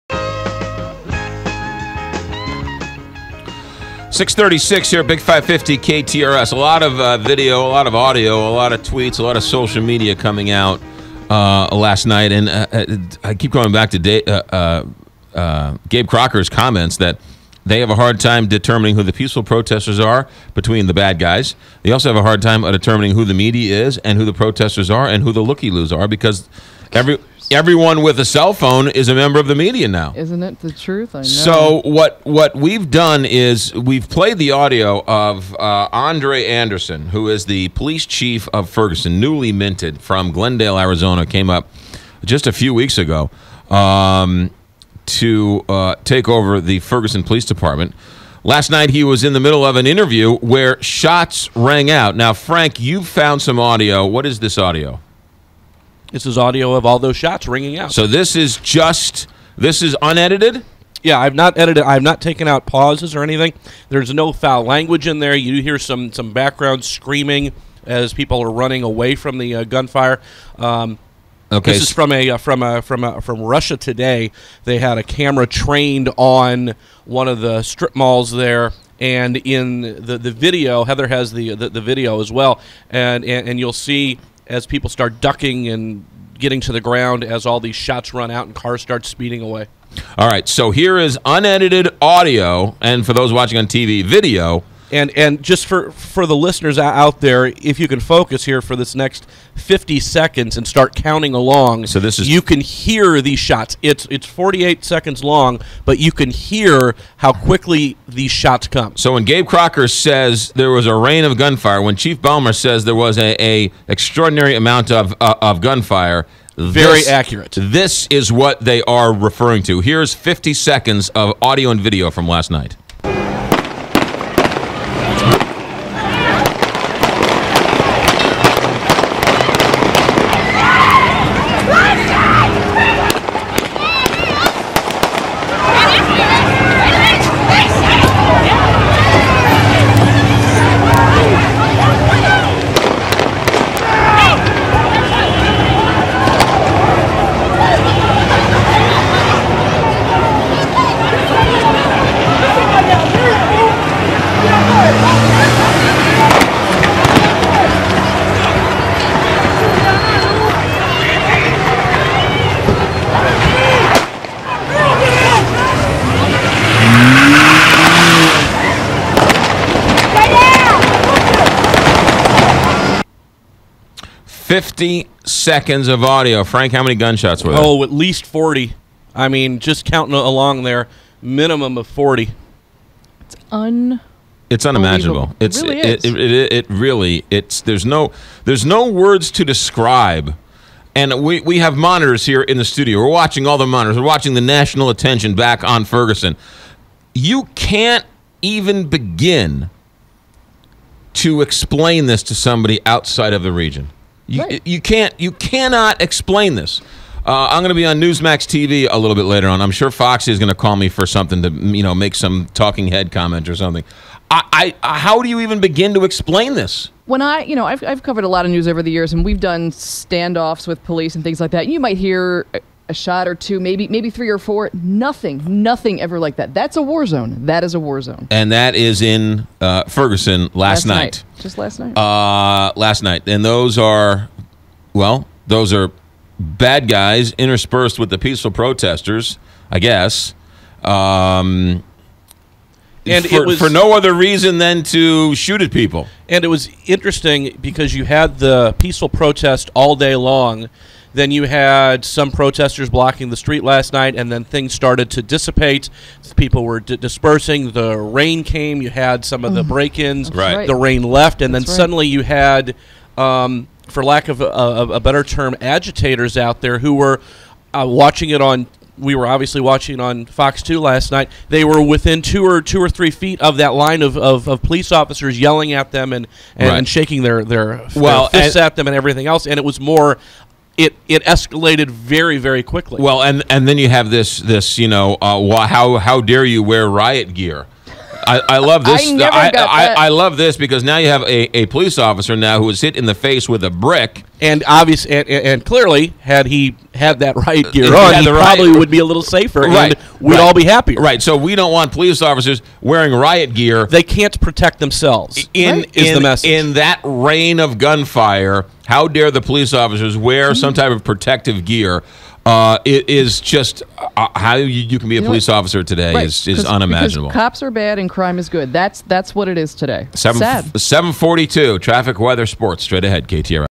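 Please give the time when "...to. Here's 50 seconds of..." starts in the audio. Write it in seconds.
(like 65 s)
119 s.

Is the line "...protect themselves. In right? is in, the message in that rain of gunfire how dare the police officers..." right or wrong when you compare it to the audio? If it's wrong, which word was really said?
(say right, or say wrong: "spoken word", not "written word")
right.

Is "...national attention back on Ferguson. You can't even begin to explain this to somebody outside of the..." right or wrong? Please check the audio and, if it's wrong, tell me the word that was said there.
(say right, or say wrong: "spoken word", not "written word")
right.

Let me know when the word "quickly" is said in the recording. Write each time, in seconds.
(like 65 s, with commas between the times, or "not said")
107 s, 282 s.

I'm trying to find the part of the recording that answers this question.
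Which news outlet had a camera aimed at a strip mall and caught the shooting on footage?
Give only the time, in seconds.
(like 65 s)
73 s.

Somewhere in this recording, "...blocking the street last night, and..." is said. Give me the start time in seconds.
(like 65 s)
252 s.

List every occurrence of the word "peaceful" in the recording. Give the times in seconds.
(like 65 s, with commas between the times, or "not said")
19 s, 238 s, 248 s.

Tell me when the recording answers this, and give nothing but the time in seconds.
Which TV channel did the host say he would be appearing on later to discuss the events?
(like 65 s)
207 s.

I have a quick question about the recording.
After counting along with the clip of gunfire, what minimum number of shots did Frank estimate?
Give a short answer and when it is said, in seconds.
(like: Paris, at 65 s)
40, at 181 s.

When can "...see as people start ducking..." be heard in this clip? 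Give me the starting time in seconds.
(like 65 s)
83 s.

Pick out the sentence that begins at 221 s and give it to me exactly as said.
You might hear a shot or two, maybe maybe three or four.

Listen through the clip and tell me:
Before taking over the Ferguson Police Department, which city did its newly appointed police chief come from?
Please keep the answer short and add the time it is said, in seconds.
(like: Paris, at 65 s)
Glendale, Arizona, at 40 s.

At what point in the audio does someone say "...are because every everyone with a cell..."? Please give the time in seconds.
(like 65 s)
25 s.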